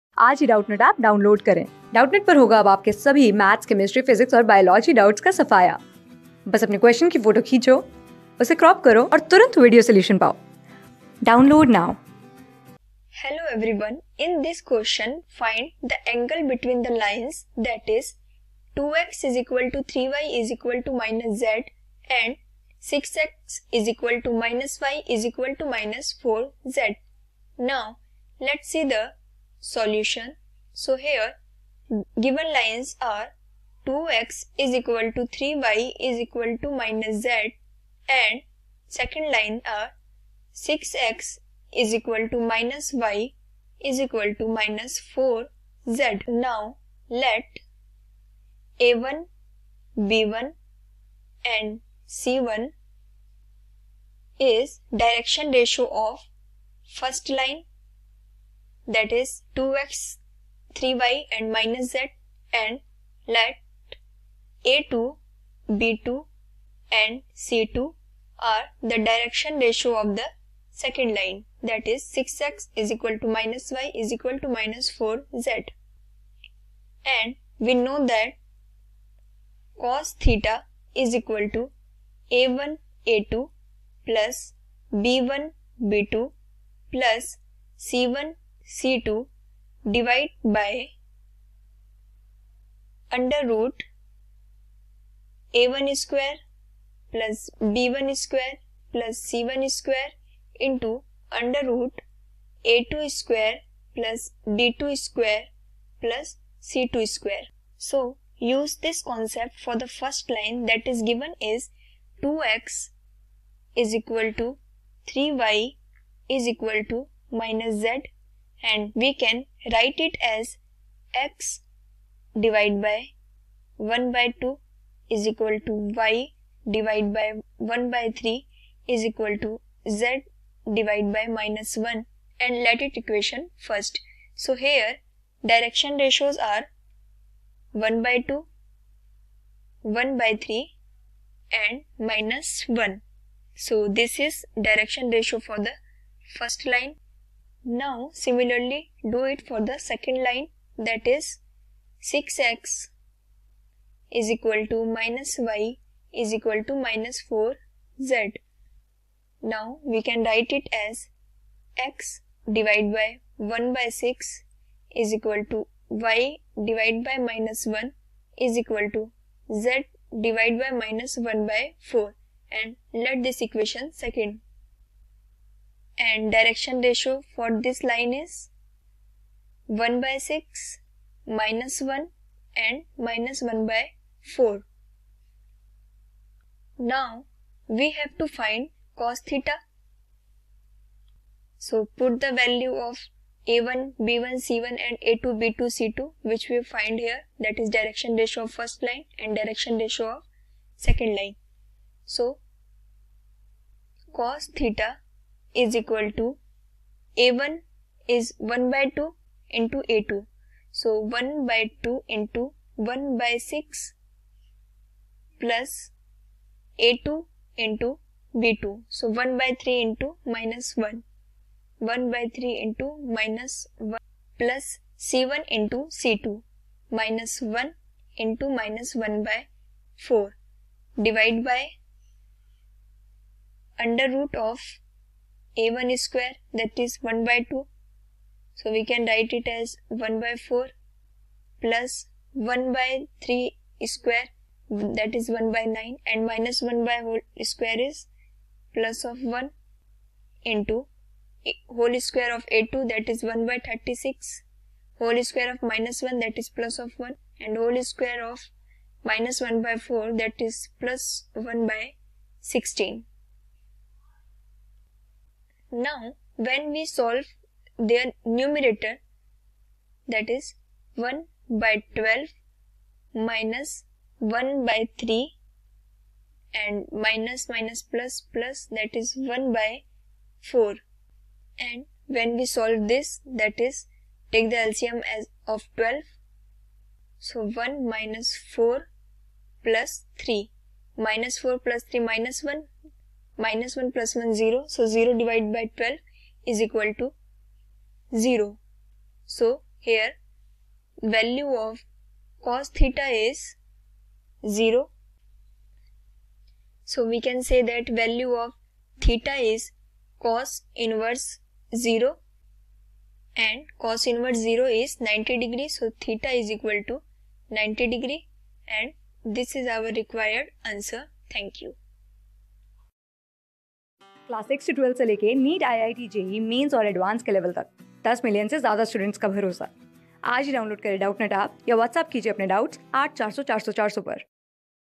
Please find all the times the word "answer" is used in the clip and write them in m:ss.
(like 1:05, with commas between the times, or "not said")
5:20.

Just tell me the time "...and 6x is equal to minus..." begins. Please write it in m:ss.
0:22.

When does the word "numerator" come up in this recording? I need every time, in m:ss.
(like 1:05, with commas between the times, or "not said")
4:28.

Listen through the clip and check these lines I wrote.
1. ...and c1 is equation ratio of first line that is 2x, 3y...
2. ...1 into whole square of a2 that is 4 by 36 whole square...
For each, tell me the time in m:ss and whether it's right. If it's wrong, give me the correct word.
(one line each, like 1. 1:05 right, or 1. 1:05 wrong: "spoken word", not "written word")
1. 0:51 wrong: "direction", not "equation"
2. 4:09 wrong: "1", not "4".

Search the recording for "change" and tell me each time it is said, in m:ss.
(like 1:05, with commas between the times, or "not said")
not said.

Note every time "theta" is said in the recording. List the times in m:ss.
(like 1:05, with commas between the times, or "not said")
1:20, 3:09, 3:24, 5:02, 5:09, 5:16.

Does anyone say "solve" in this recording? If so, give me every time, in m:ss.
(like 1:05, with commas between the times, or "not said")
4:26, 4:42.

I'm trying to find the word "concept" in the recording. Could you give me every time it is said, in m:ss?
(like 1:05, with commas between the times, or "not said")
1:49.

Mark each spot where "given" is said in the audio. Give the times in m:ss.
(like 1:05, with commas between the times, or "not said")
0:32, 1:51.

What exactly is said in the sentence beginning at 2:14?
So here direction ratios are 1 by 2, 1 by 3 and minus 1.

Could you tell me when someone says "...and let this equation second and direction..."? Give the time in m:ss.
2:52.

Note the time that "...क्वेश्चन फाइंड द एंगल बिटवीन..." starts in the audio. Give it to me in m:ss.
0:14.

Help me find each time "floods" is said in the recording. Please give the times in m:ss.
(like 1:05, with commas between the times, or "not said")
not said.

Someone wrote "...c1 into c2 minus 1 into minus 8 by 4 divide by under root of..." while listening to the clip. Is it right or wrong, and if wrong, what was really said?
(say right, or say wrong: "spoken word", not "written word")
wrong: "1", not "8".